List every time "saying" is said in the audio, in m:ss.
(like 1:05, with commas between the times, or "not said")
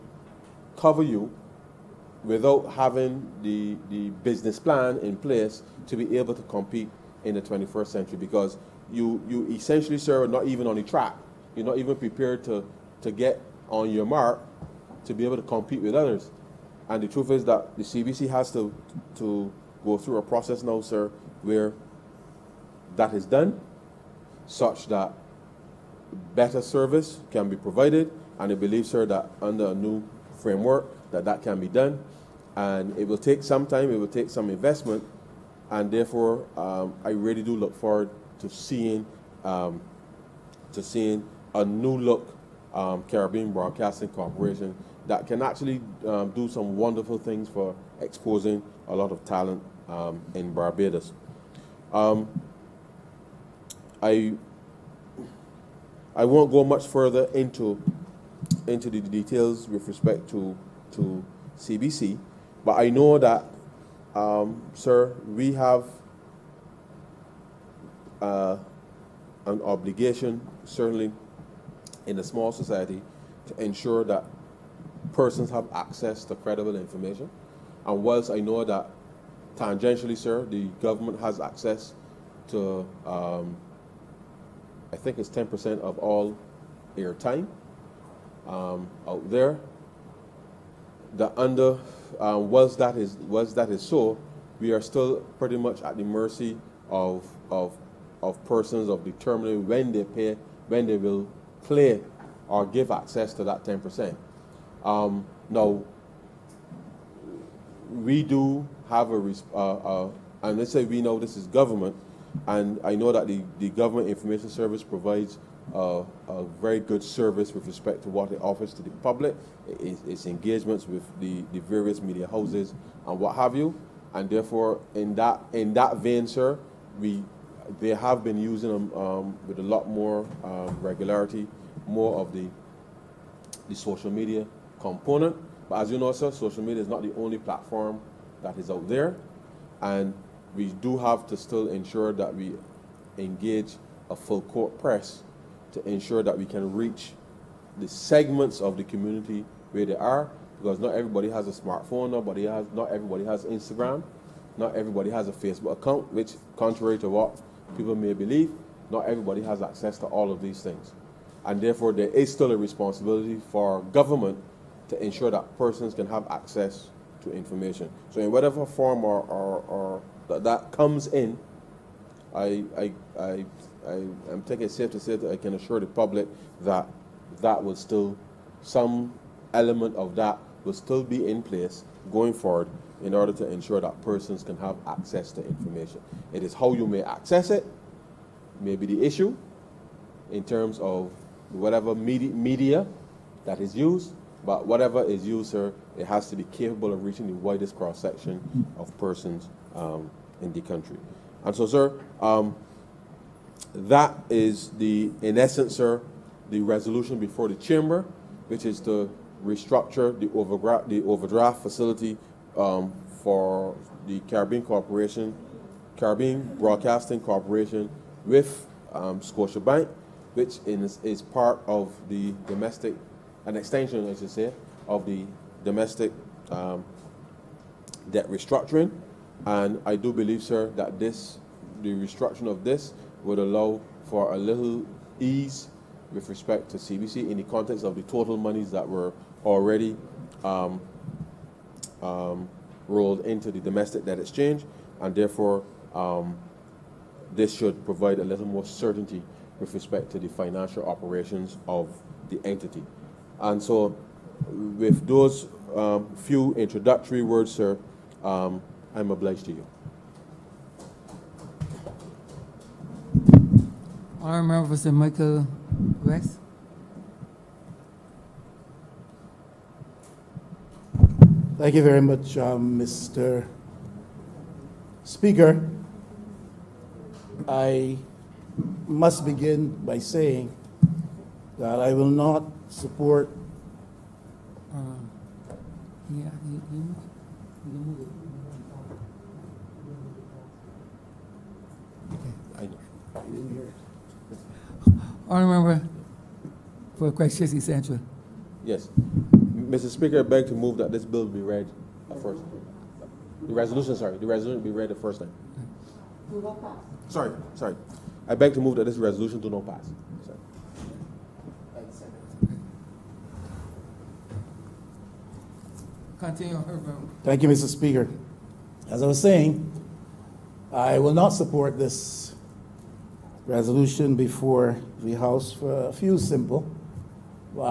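4:39, 5:19.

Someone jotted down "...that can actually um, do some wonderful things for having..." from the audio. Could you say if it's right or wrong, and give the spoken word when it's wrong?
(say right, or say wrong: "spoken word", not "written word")
wrong: "exposing", not "having".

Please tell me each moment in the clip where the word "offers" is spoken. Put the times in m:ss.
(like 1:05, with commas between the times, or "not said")
1:58.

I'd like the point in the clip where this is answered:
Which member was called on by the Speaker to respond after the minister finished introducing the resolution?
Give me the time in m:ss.
4:24.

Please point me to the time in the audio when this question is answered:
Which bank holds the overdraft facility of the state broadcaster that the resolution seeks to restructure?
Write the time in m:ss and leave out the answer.
3:39.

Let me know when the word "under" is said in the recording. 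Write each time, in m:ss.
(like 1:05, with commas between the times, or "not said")
0:29, 1:31.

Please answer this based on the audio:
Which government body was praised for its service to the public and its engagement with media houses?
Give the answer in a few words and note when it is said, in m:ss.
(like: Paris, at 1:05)
Government Information Service, at 1:53.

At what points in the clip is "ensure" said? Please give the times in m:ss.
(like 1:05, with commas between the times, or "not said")
1:13, 2:21, 2:25, 2:45, 3:03.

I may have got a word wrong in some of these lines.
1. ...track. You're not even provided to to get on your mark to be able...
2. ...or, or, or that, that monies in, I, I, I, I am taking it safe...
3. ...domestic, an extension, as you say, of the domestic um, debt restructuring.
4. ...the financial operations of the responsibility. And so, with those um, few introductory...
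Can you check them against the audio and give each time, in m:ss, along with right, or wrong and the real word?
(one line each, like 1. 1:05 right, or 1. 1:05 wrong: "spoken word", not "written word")
1. 0:10 wrong: "prepared", not "provided"
2. 2:49 wrong: "comes", not "monies"
3. 3:42 right
4. 4:10 wrong: "entity", not "responsibility".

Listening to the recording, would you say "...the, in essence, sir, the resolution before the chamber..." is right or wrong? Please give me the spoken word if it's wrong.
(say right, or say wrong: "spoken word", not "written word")
right.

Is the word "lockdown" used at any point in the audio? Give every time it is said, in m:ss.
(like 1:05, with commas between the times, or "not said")
not said.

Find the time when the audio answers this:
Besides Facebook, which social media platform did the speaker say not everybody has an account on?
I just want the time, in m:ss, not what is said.
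2:33.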